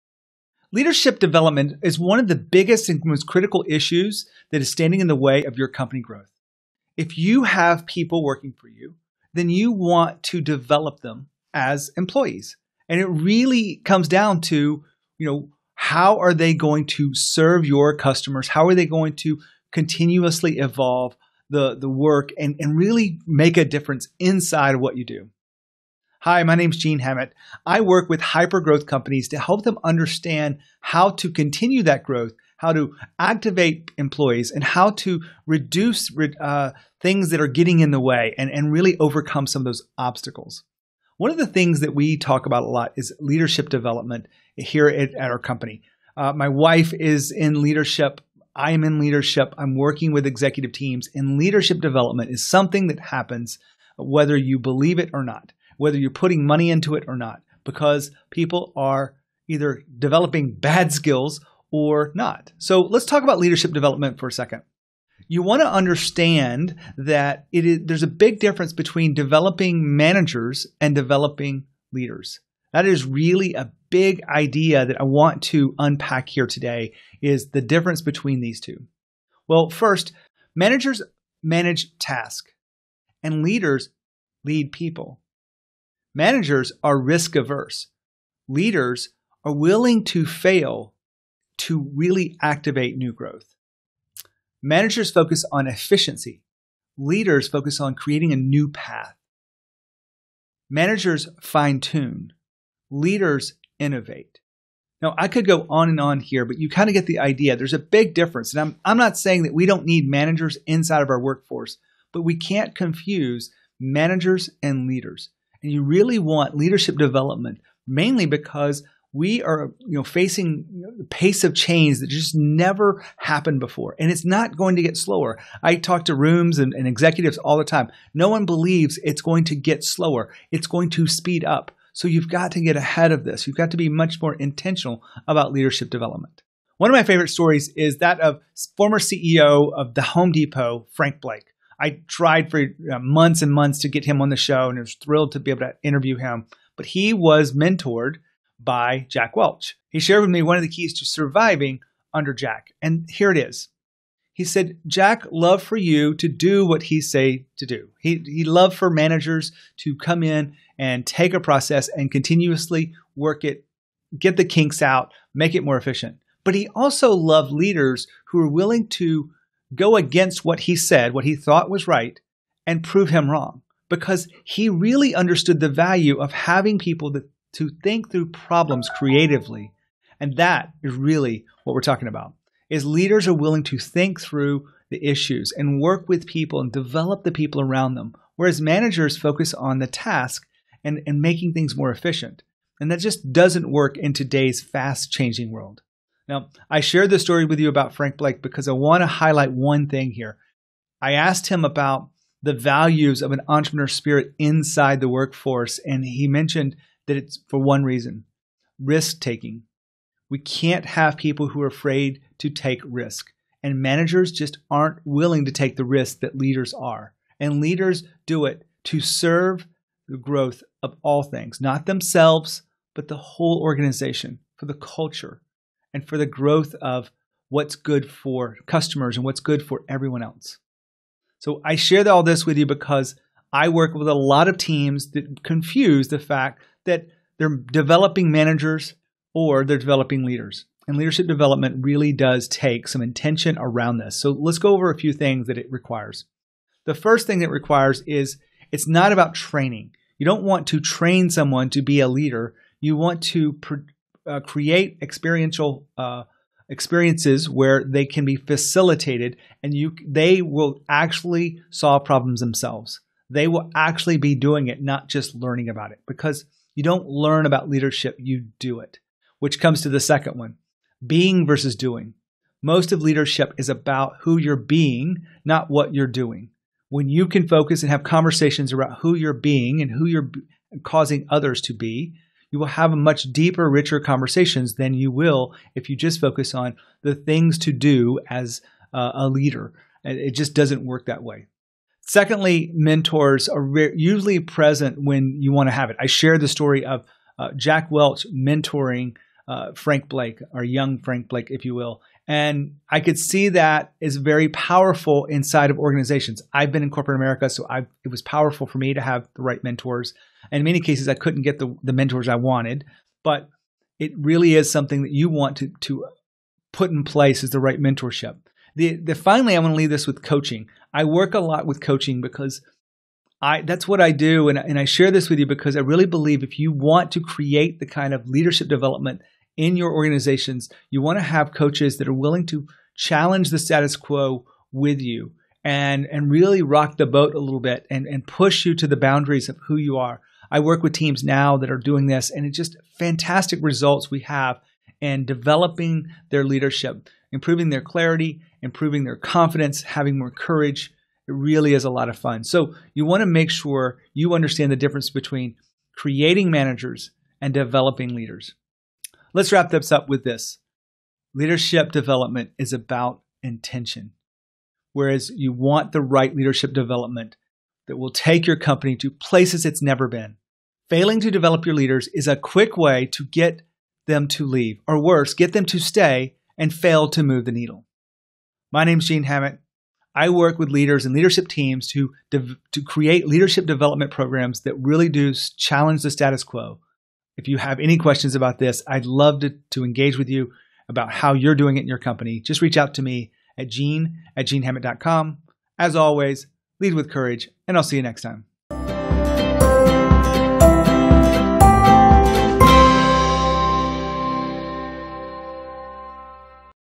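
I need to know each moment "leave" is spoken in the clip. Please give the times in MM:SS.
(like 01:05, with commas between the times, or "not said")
05:19, 06:14.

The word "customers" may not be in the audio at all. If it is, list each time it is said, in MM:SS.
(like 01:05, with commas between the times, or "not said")
00:17, 03:48.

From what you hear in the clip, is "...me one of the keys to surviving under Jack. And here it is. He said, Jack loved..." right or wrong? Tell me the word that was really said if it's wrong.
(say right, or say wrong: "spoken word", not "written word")
right.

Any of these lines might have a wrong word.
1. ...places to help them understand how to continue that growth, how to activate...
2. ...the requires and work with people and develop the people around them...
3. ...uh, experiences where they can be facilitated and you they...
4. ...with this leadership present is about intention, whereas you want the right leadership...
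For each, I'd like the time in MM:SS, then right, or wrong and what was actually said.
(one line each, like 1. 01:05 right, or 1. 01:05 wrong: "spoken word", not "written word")
1. 00:28 wrong: "companies", not "places"
2. 03:04 wrong: "issues", not "requires"
3. 04:15 right
4. 06:00 wrong: "development", not "present".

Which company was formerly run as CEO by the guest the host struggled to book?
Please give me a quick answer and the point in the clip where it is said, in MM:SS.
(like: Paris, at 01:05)
The Home Depot, at 02:19.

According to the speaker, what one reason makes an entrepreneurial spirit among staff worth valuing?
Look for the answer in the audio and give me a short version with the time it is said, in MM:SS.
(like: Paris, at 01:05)
Risk taking, at 03:28.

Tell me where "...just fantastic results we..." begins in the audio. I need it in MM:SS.
05:42.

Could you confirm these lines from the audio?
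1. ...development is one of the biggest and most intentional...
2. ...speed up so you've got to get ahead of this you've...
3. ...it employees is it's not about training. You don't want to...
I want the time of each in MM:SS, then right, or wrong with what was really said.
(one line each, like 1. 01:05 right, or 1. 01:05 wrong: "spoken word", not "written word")
1. 00:01 wrong: "critical", not "intentional"
2. 02:11 right
3. 04:07 wrong: "requires", not "employees".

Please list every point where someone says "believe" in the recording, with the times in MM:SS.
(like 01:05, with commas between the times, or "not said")
00:54, 02:08, 05:26.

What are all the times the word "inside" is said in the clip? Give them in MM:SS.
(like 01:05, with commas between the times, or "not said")
00:24, 01:50, 03:24, 05:05.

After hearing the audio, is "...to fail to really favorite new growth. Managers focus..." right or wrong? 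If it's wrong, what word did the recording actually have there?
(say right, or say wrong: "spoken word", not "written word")
wrong: "activate", not "favorite".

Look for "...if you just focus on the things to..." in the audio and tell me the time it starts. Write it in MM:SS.
04:45.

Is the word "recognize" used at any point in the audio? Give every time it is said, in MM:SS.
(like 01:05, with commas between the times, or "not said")
not said.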